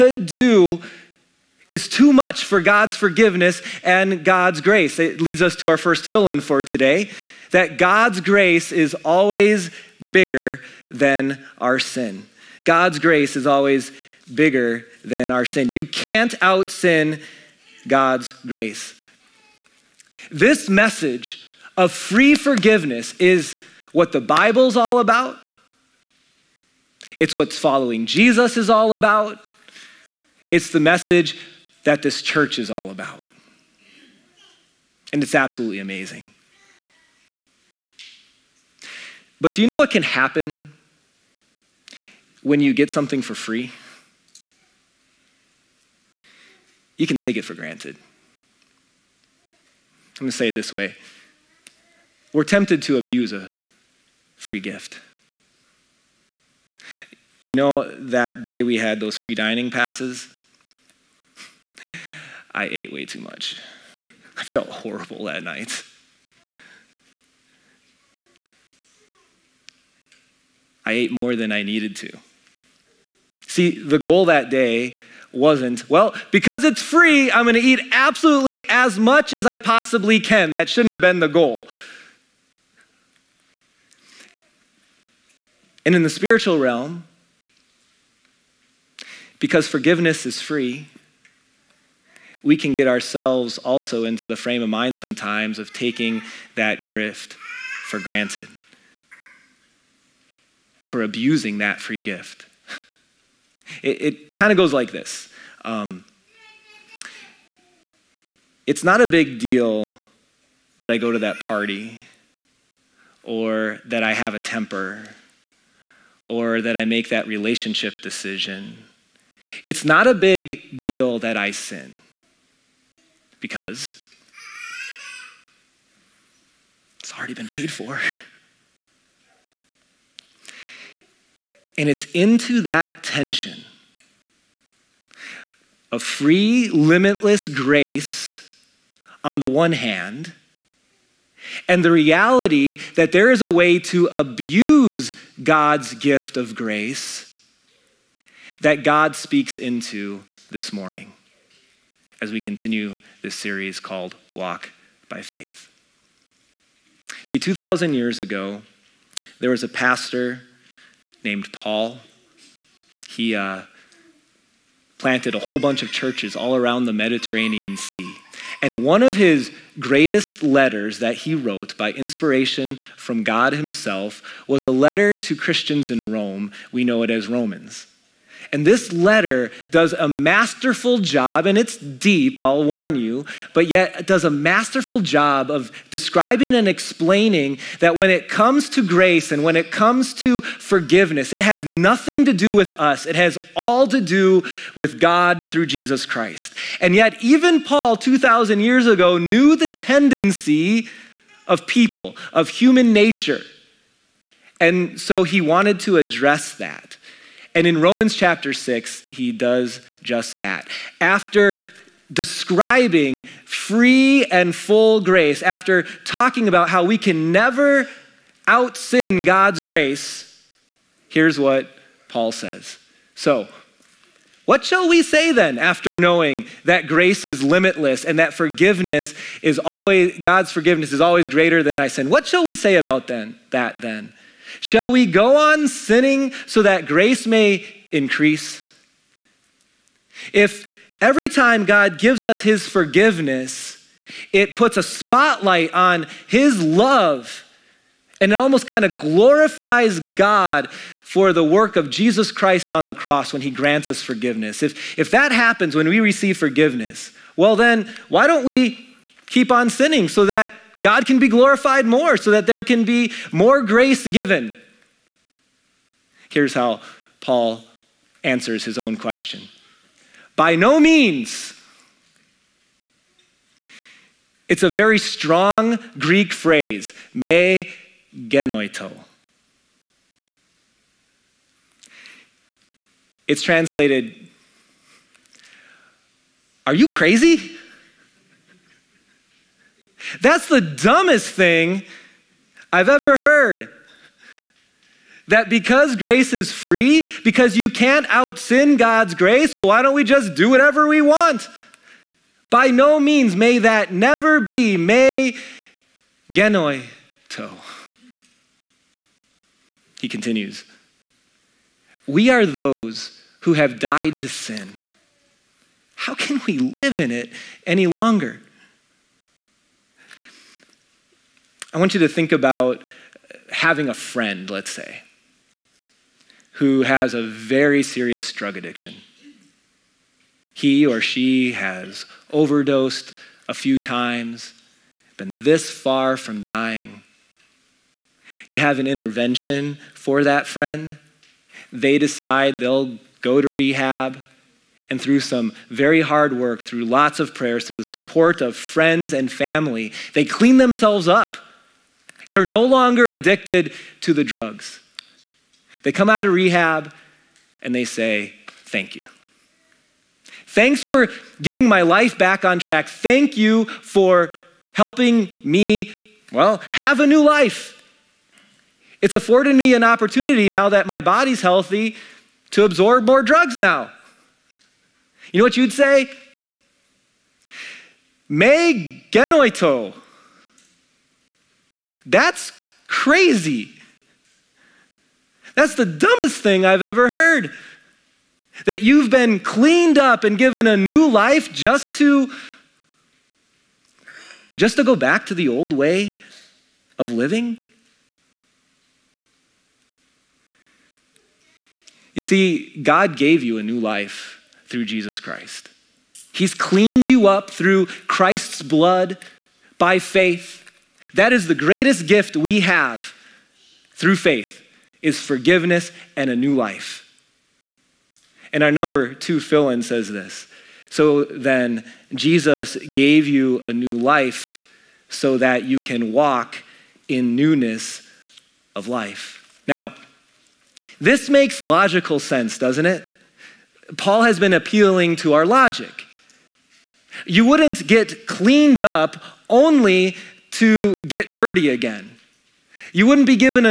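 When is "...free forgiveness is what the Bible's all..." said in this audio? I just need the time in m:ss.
0:21.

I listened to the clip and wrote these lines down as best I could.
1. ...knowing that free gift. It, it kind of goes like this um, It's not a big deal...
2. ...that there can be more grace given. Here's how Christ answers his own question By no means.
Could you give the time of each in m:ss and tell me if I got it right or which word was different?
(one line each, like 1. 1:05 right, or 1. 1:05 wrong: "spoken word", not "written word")
1. 1:41 wrong: "abusing", not "knowing"
2. 4:22 wrong: "Paul", not "Christ".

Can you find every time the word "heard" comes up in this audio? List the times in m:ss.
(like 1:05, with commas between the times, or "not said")
4:53, 6:27.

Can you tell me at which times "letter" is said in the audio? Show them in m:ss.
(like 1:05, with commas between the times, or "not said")
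2:50, 2:54, 2:58.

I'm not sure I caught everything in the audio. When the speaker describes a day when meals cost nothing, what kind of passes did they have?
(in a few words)
free dining passes.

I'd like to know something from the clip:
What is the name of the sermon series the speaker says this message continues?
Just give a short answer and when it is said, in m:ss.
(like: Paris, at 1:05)
Walk by Faith, at 2:34.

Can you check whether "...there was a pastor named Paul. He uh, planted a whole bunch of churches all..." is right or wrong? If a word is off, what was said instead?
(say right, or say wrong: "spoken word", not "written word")
right.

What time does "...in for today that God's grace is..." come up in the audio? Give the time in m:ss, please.
0:06.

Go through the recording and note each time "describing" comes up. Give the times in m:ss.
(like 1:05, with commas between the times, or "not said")
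3:05, 3:32.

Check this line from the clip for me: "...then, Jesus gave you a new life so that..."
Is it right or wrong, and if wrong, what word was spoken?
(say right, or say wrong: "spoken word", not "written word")
right.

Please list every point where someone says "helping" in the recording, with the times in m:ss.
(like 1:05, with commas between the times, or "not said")
6:04.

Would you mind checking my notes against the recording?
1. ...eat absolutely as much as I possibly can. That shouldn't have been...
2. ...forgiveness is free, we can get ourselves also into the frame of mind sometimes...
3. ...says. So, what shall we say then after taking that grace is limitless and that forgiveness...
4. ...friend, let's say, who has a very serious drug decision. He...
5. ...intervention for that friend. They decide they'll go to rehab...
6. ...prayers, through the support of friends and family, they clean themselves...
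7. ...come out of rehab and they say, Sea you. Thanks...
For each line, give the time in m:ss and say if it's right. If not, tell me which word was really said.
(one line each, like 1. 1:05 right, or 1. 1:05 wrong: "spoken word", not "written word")
1. 1:17 right
2. 1:29 right
3. 3:42 wrong: "knowing", not "taking"
4. 5:23 wrong: "addiction", not "decision"
5. 5:38 right
6. 5:47 right
7. 5:55 wrong: "Thank", not "Sea".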